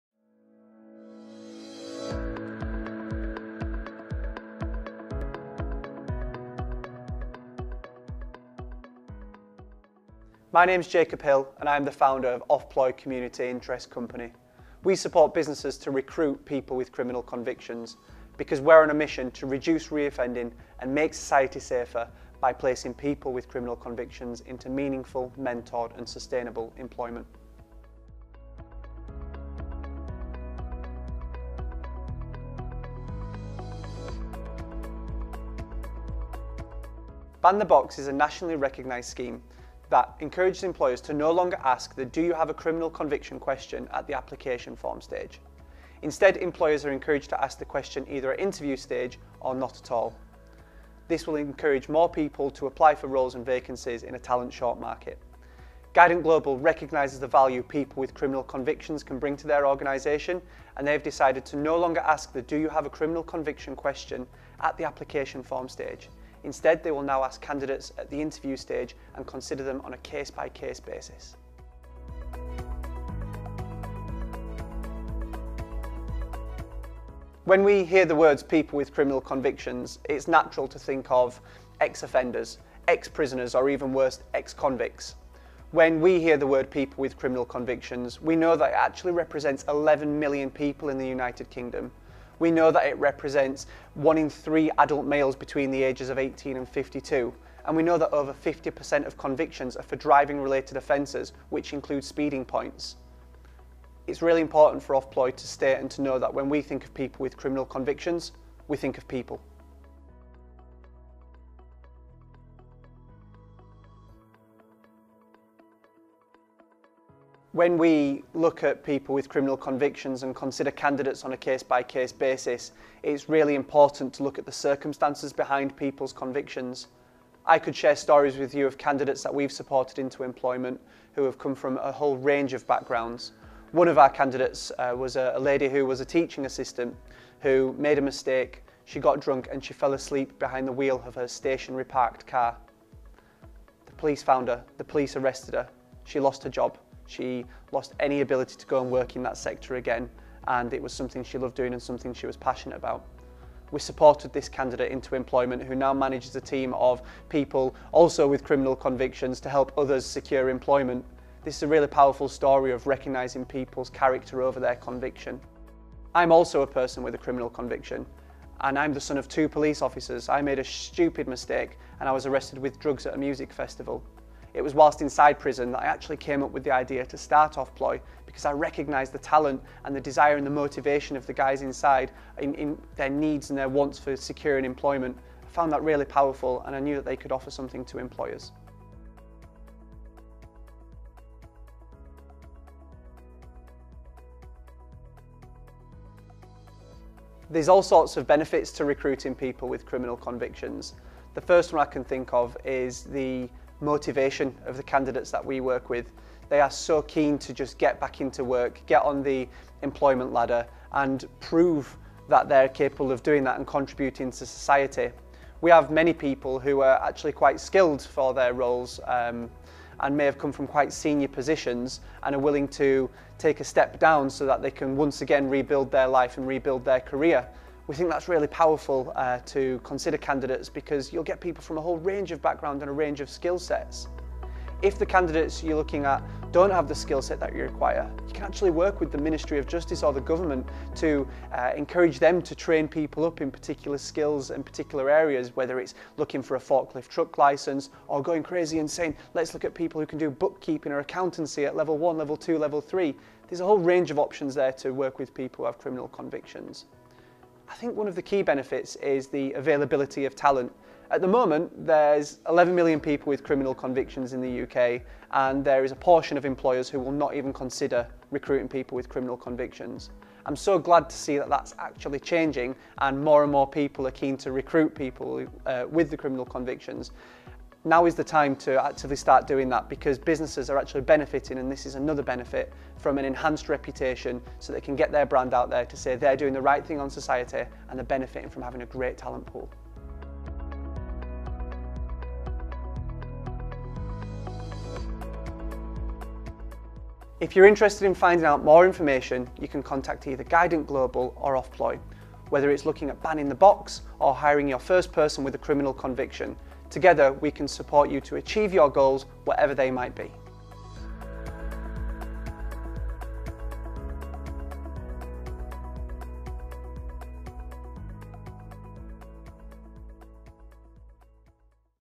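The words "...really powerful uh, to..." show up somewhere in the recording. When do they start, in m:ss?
3:48.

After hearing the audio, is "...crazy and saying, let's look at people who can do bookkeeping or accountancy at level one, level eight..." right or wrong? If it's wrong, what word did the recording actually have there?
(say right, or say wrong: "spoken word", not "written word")
wrong: "two", not "eight".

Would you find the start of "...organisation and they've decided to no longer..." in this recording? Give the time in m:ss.
0:59.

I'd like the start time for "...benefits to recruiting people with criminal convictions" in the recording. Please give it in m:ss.
3:18.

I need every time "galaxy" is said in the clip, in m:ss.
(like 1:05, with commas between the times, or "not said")
not said.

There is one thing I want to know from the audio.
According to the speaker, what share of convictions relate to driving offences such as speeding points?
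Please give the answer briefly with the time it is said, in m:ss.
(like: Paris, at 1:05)
over 50%, at 1:38.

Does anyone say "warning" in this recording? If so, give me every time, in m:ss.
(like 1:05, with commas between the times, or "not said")
not said.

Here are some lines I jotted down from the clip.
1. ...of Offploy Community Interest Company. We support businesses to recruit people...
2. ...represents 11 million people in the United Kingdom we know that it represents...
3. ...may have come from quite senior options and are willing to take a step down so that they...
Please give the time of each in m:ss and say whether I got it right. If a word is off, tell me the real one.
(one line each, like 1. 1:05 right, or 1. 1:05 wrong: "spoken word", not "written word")
1. 0:12 right
2. 1:29 right
3. 3:40 wrong: "positions", not "options".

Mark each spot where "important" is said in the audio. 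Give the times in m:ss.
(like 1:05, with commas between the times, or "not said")
1:44, 2:03.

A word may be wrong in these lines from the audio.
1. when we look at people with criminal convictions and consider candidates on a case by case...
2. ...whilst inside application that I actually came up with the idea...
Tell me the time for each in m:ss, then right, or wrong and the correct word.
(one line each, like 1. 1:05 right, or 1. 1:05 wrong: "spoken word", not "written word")
1. 1:57 right
2. 2:54 wrong: "prison", not "application".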